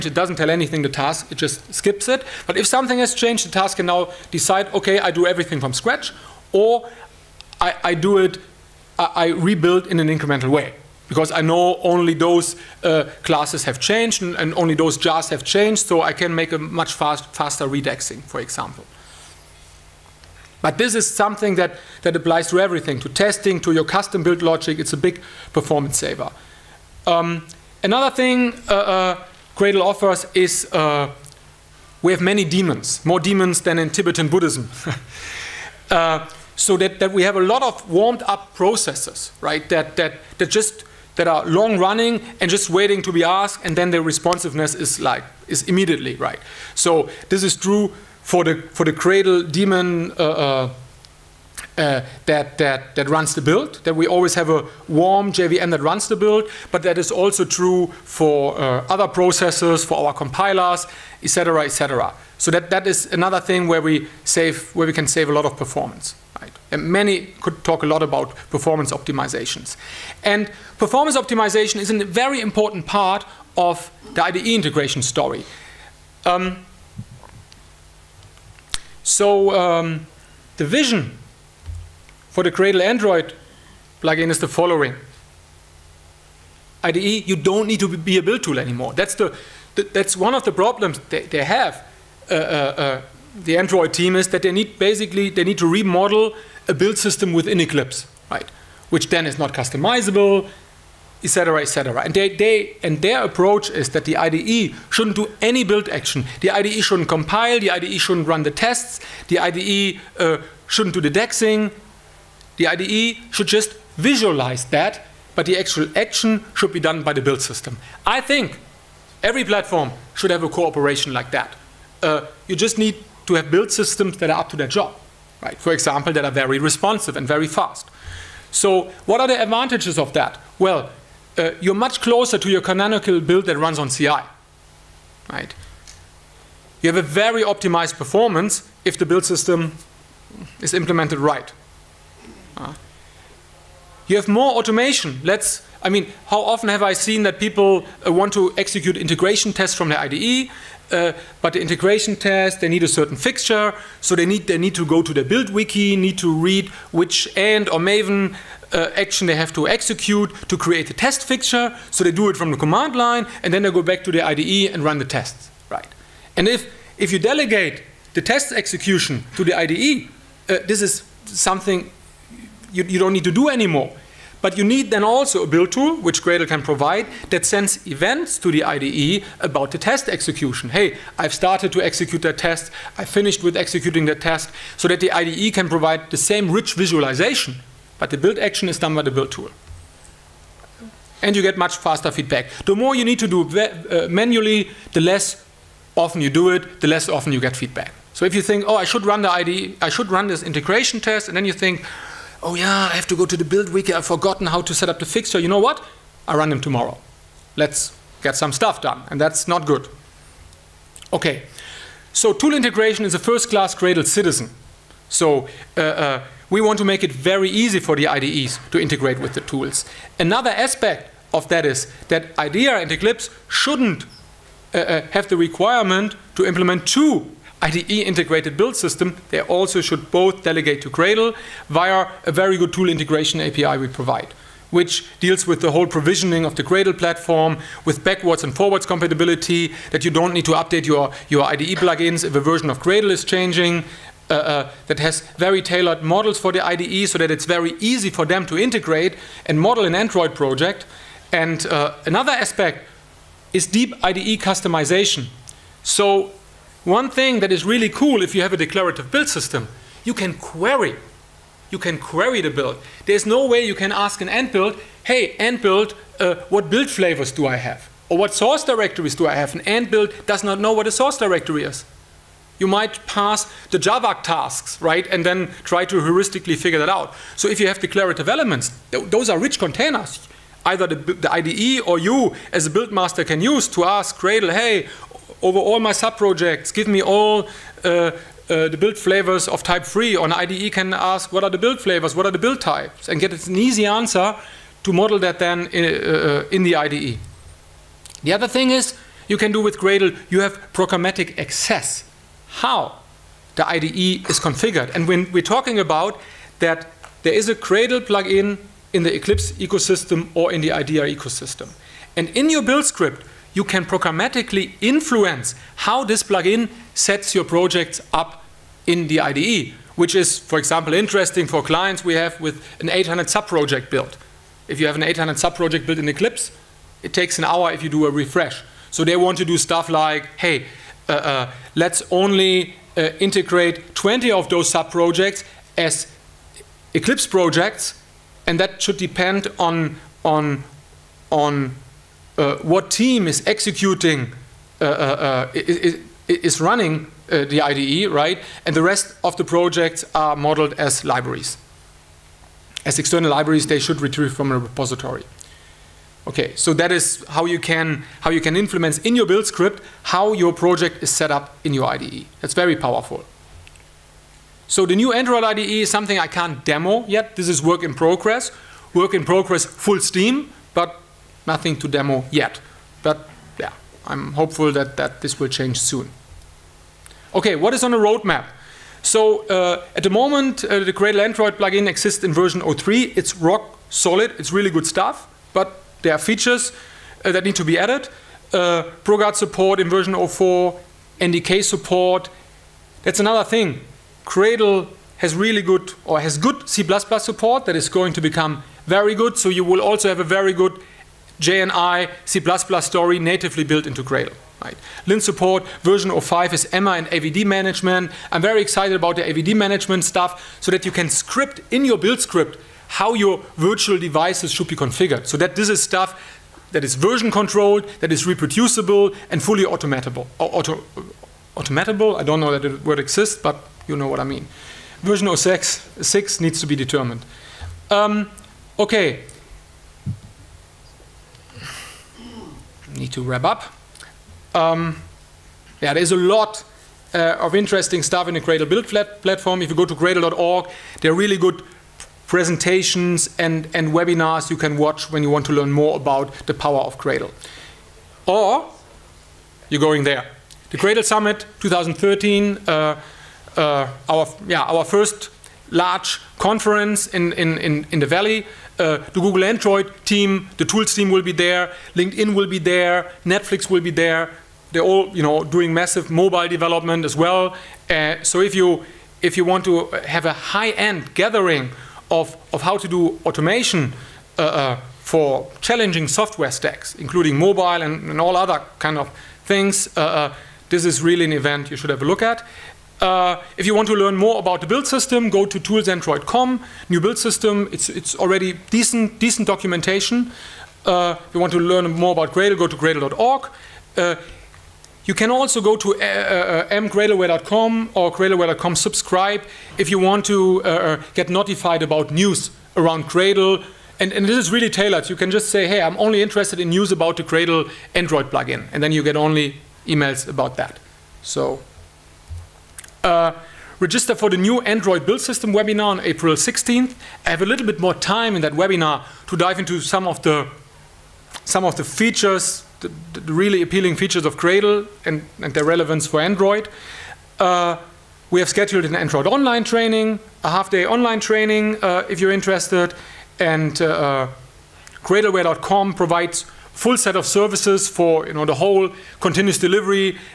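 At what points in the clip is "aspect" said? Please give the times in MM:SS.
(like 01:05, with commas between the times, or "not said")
03:40, 04:12.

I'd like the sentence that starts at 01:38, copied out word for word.
Which then is not customizable, etc., etc.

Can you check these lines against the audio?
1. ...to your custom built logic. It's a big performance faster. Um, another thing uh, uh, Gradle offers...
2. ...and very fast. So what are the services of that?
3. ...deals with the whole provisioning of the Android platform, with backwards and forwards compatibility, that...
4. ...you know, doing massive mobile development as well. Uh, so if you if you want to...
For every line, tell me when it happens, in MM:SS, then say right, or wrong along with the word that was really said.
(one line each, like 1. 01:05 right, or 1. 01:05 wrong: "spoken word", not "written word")
1. 00:23 wrong: "saver", not "faster"
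2. 02:07 wrong: "advantages", not "services"
3. 03:55 wrong: "Gradle", not "Android"
4. 07:45 right.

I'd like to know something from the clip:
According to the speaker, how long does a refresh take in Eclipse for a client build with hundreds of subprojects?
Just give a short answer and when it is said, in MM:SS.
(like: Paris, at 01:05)
an hour, at 05:27.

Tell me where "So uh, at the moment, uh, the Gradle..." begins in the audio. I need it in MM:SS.
06:19.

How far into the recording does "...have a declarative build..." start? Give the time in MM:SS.
04:18.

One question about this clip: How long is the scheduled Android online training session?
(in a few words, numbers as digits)
half-day.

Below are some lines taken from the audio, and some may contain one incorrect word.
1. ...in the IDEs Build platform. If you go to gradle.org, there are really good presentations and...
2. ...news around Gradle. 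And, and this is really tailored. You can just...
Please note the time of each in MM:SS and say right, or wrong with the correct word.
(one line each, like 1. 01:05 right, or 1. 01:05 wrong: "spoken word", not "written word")
1. 07:18 wrong: "Gradle", not "IDEs"
2. 08:22 right.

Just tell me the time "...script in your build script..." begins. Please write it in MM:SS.
06:51.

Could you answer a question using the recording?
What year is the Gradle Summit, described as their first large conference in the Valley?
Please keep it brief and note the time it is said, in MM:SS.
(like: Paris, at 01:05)
2013, at 07:31.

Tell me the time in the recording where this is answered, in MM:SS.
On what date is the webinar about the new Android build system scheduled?
08:36.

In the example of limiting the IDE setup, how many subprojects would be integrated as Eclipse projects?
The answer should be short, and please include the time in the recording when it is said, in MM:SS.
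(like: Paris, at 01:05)
20, at 05:33.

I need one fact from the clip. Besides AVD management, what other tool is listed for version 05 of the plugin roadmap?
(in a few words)
Emma.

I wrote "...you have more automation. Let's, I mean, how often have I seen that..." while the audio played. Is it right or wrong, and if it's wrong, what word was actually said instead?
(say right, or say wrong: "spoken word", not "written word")
right.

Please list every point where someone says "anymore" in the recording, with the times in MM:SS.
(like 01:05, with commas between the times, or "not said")
01:28, 02:53.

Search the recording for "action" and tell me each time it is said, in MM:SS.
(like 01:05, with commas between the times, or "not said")
01:45, 01:55, 02:38, 03:08.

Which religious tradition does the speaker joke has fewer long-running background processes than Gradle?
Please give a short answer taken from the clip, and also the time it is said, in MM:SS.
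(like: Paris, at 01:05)
Tibetan Buddhism, at 00:33.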